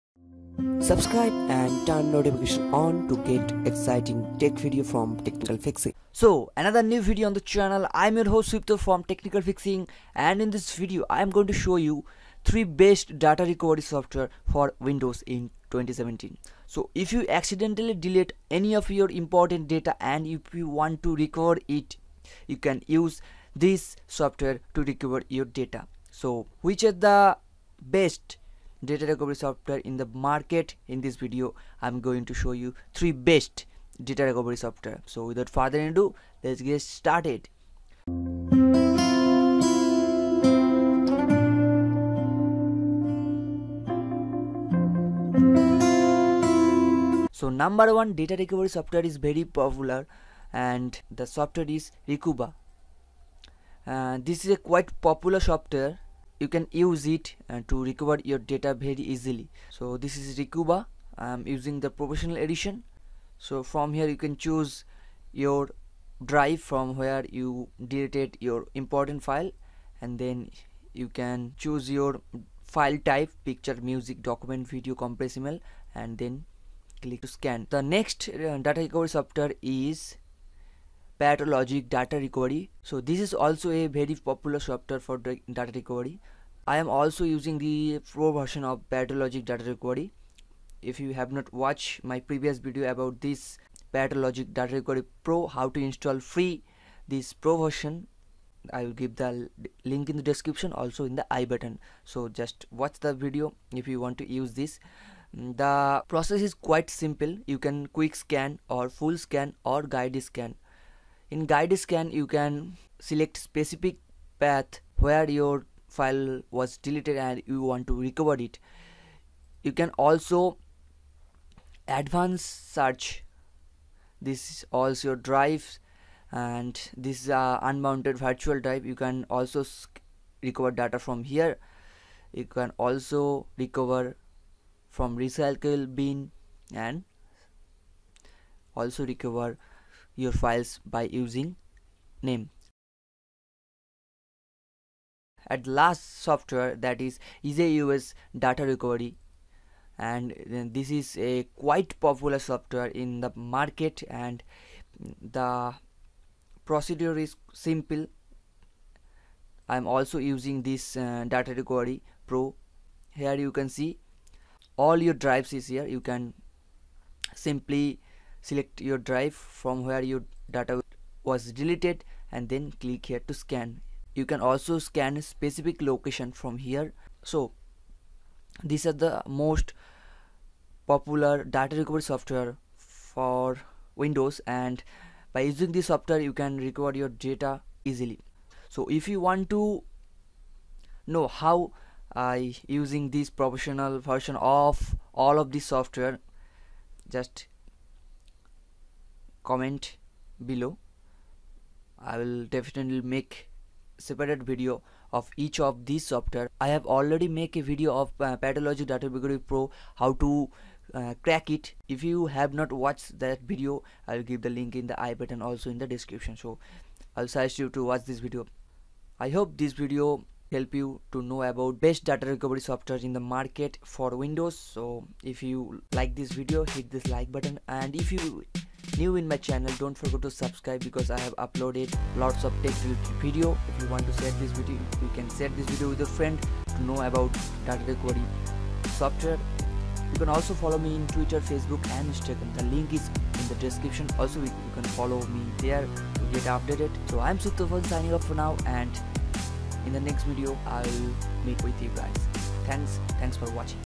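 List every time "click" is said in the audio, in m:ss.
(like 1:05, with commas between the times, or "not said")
1:17, 2:52.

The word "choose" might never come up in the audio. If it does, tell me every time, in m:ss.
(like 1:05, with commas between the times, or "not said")
1:04, 1:11.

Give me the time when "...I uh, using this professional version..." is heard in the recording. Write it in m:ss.
3:12.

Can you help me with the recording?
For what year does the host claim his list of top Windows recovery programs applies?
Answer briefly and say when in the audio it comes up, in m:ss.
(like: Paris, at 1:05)
2017, at 0:15.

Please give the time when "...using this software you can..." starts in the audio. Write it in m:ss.
3:05.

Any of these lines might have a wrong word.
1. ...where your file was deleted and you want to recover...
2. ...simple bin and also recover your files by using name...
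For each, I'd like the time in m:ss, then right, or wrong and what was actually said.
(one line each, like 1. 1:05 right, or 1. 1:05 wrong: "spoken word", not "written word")
1. 1:54 right
2. 2:15 wrong: "recycle", not "simple".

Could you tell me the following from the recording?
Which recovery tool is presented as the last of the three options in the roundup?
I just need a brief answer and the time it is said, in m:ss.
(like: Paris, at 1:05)
EaseUS data recovery, at 2:27.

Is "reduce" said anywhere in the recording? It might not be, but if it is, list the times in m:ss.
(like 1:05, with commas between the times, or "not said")
not said.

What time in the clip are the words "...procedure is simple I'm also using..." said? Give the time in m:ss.
2:36.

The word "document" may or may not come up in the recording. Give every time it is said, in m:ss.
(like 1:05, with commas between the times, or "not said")
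1:14.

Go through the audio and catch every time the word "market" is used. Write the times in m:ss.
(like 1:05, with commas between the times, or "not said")
0:30, 2:33, 3:43.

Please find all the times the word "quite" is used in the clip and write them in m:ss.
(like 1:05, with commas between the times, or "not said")
0:54, 1:46, 2:31.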